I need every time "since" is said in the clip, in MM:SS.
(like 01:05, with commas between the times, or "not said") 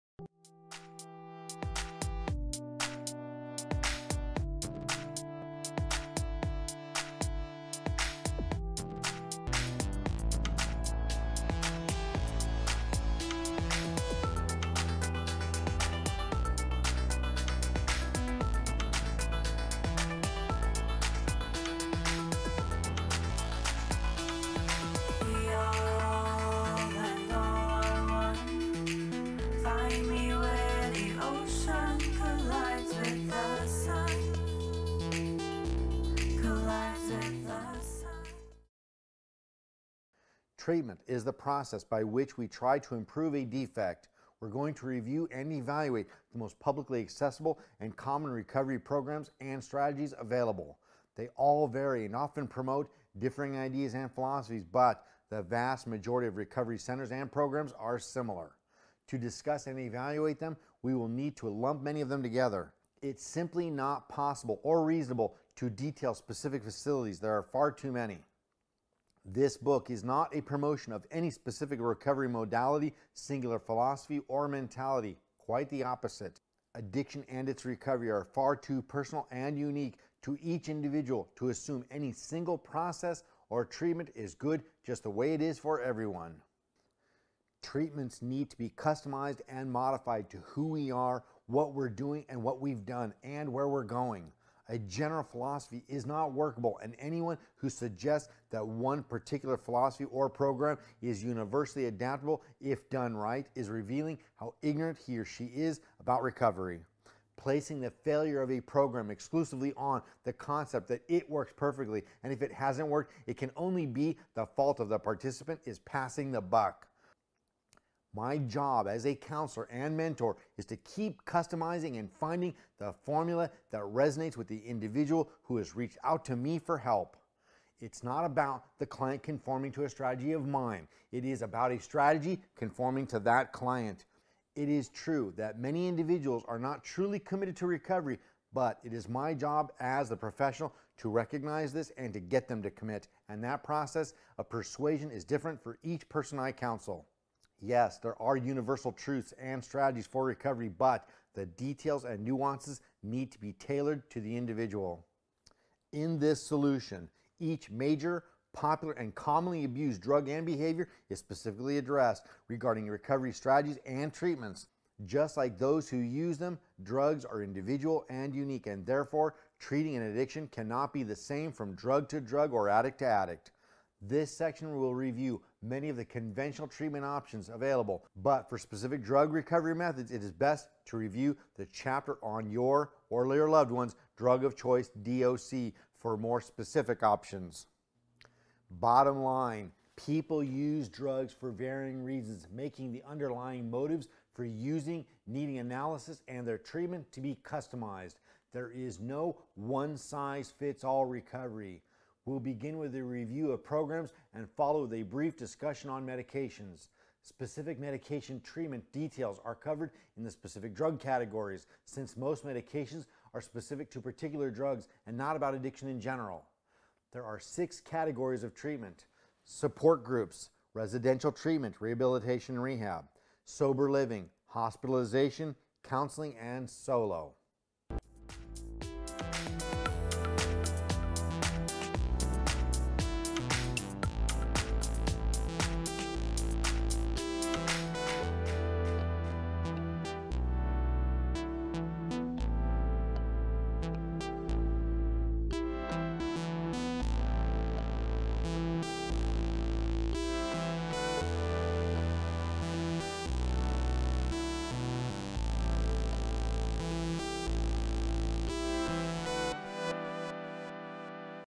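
03:31.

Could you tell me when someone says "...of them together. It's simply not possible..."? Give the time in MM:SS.
01:02.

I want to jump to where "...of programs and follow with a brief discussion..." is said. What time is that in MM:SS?
03:23.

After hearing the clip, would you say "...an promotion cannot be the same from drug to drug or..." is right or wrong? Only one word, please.
wrong.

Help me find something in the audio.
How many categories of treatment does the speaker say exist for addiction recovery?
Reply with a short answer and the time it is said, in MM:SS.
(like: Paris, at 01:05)
6, at 03:37.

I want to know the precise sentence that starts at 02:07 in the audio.
It's not about the client conforming to a strategy of mine.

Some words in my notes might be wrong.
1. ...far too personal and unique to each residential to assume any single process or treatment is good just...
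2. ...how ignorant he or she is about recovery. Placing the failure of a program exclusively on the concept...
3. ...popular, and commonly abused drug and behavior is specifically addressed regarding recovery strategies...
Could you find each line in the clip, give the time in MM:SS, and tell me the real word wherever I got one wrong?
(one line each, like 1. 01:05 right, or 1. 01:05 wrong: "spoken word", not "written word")
1. 01:18 wrong: "individual", not "residential"
2. 01:44 right
3. 02:38 right.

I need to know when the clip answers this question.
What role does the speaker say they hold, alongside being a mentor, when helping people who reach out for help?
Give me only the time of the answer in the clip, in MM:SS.
01:59.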